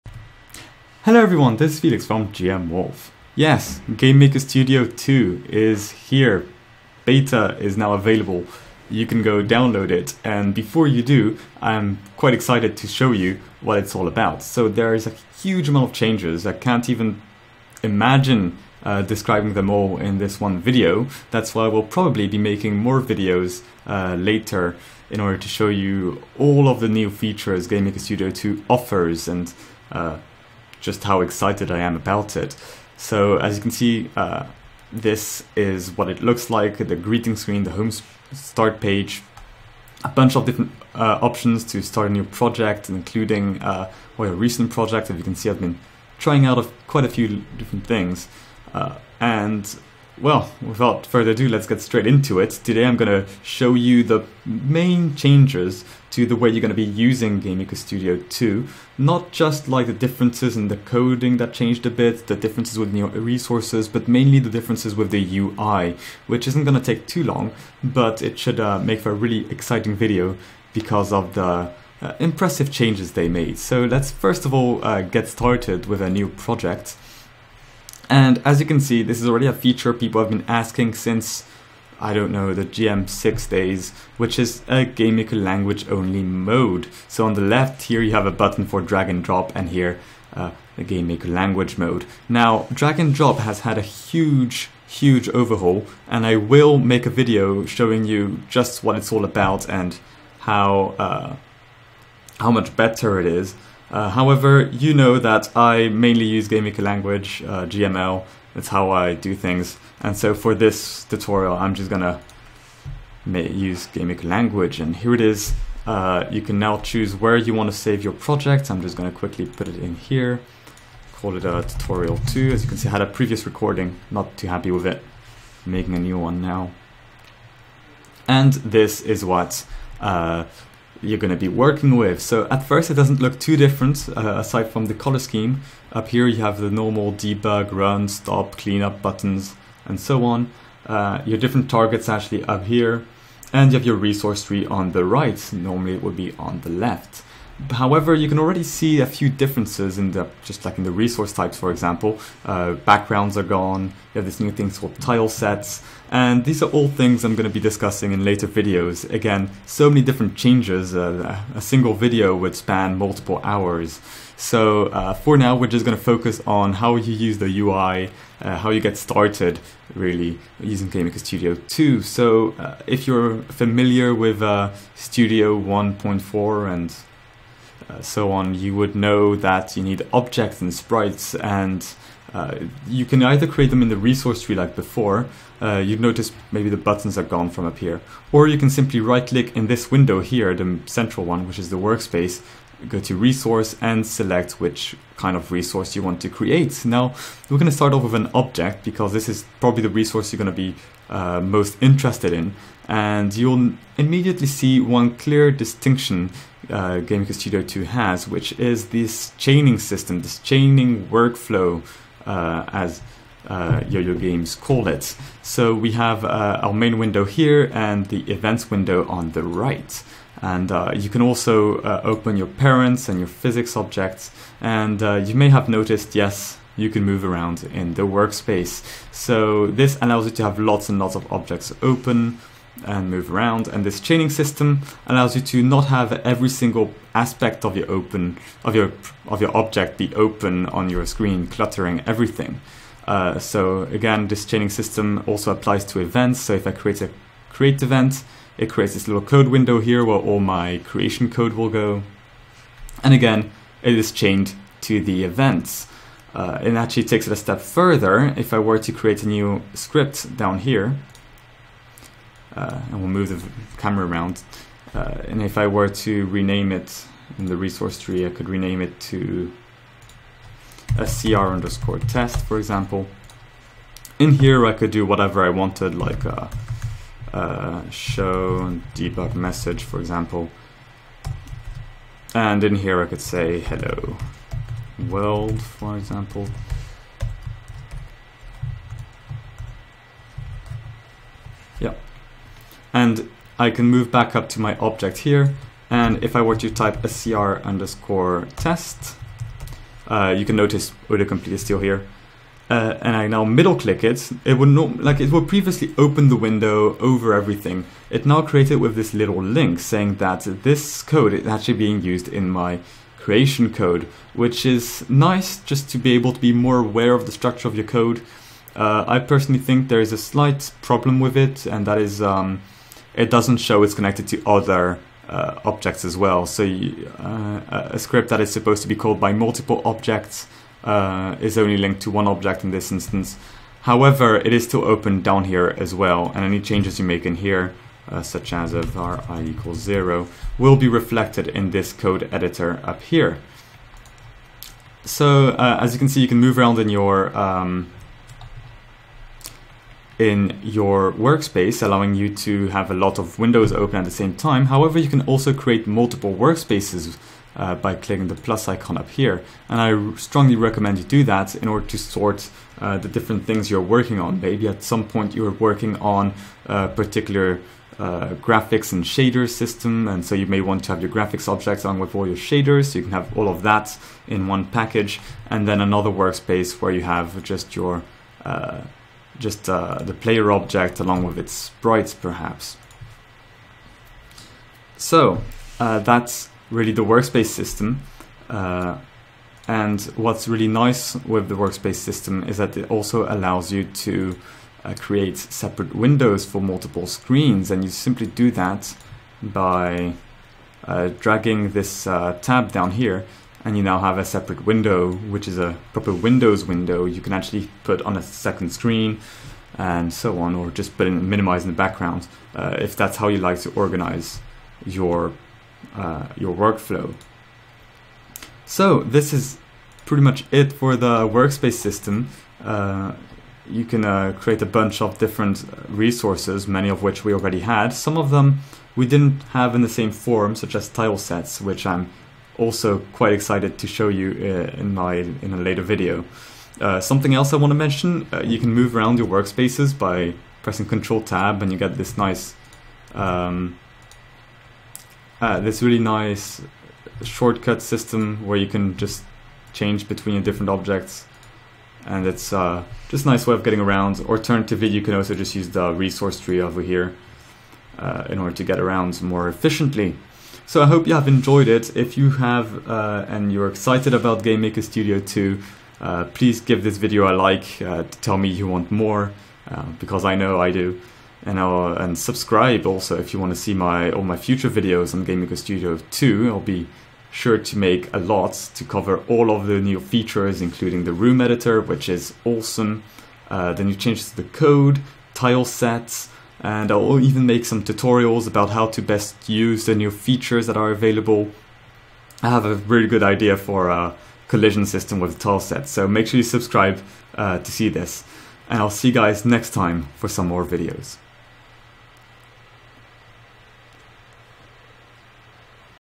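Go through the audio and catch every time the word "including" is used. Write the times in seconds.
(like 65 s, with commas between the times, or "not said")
42 s, 480 s.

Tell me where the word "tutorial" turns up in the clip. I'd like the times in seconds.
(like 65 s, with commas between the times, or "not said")
111 s, 121 s, 487 s.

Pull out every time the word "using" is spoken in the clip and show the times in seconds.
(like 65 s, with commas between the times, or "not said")
56 s, 170 s.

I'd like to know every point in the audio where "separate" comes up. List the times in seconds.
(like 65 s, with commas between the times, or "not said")
395 s, 404 s.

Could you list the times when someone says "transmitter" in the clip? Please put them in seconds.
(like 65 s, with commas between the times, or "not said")
not said.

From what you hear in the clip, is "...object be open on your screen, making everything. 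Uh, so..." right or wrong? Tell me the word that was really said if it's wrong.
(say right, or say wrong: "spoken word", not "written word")
wrong: "cluttering", not "making".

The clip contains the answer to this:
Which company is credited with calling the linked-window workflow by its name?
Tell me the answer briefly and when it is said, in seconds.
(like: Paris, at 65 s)
Yo-Yo Games, at 213 s.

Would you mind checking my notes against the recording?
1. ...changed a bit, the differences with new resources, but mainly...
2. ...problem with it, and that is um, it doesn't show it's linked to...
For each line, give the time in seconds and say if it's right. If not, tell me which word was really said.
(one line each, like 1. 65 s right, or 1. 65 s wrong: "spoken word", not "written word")
1. 61 s right
2. 320 s wrong: "connected", not "linked".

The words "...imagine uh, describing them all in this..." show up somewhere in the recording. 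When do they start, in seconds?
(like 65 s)
17 s.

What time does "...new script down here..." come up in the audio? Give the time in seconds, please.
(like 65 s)
259 s.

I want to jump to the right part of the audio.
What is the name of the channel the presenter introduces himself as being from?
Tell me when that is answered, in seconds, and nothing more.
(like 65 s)
2 s.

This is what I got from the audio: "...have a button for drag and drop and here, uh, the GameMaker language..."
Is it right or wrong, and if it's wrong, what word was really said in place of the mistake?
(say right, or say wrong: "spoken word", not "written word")
right.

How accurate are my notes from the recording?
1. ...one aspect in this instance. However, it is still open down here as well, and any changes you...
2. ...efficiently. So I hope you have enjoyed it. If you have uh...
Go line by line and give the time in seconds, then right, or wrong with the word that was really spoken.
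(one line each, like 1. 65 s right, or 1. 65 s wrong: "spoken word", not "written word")
1. 332 s wrong: "object", not "aspect"
2. 459 s right.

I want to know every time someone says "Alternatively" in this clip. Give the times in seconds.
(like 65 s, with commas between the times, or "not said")
454 s.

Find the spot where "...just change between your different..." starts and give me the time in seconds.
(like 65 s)
448 s.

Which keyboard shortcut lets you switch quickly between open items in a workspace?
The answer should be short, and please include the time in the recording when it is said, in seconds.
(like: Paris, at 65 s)
Control Tab, at 440 s.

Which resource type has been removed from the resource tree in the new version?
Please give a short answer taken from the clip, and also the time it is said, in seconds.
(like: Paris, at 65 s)
backgrounds, at 152 s.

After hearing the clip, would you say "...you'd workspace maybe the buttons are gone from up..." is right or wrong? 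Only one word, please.
wrong.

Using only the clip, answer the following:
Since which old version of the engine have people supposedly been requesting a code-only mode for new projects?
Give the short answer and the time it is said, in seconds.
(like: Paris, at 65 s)
GM6, at 82 s.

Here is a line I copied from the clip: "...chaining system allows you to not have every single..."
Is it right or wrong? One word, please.
right.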